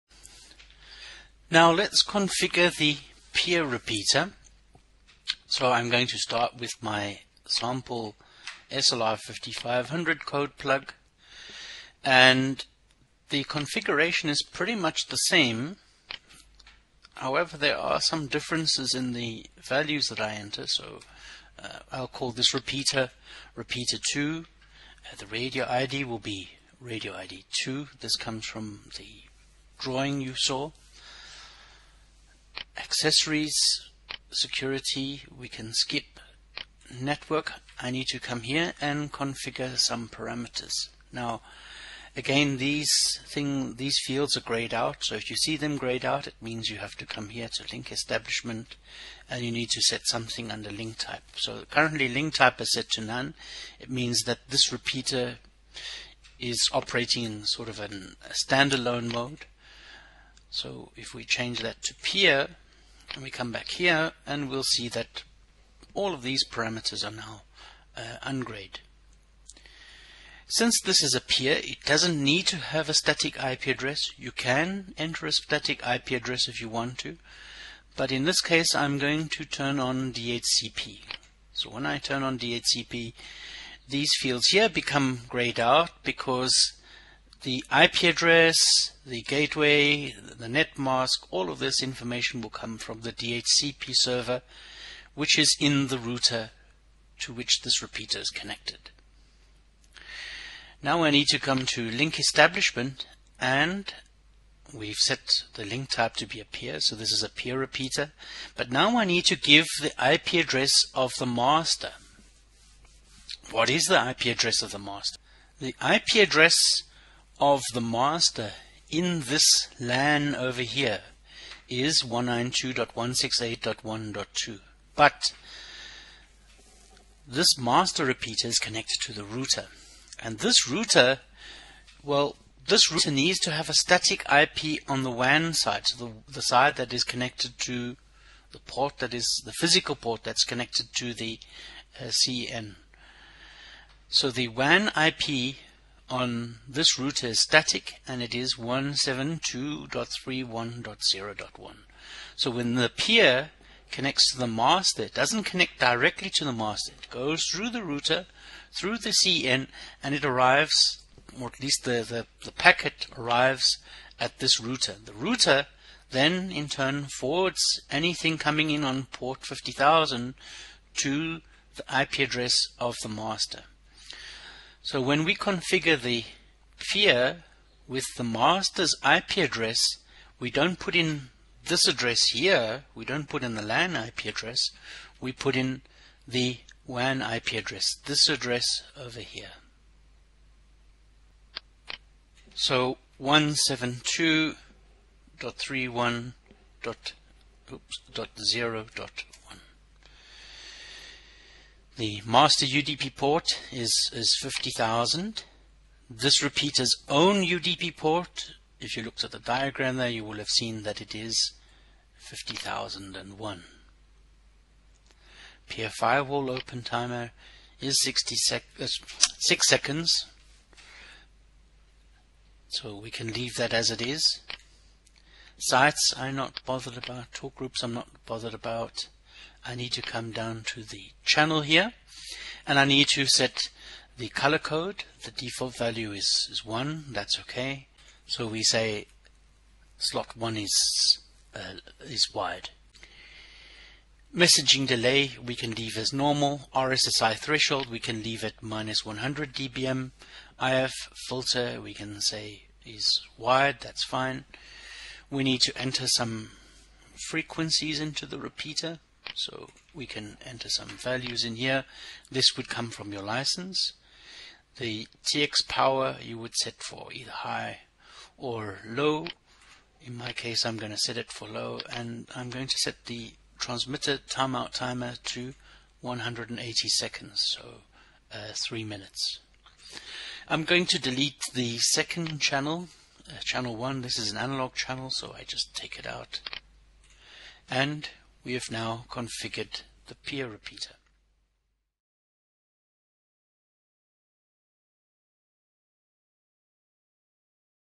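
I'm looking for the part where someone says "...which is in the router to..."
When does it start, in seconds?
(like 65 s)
95 s.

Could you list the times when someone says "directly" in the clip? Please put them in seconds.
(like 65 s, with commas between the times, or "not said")
155 s.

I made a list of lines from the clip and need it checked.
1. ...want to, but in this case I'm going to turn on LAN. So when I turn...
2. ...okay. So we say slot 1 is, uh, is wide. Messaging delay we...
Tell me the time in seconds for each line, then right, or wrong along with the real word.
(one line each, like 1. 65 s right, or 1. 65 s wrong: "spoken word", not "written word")
1. 76 s wrong: "DHCP", not "LAN"
2. 237 s right.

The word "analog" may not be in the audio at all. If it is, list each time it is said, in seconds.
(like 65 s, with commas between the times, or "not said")
284 s.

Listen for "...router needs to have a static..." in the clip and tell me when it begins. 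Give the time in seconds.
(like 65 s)
132 s.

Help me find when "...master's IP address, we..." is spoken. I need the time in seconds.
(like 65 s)
178 s.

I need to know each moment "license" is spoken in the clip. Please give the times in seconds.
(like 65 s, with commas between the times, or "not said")
263 s.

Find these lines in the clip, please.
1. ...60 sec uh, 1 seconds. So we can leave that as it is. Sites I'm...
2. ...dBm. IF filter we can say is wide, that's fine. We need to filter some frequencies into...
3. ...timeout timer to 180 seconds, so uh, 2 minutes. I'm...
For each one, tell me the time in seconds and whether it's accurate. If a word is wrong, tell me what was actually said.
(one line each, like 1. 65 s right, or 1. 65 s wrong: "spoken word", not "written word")
1. 218 s wrong: "6", not "1"
2. 249 s wrong: "enter", not "filter"
3. 274 s wrong: "3", not "2".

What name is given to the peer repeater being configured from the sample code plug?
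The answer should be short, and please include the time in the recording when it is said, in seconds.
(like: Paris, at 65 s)
Repeater 2, at 23 s.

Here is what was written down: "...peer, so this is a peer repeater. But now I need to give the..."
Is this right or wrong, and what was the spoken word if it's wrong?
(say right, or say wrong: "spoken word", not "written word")
right.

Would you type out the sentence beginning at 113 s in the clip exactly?
What is the IP address of the master?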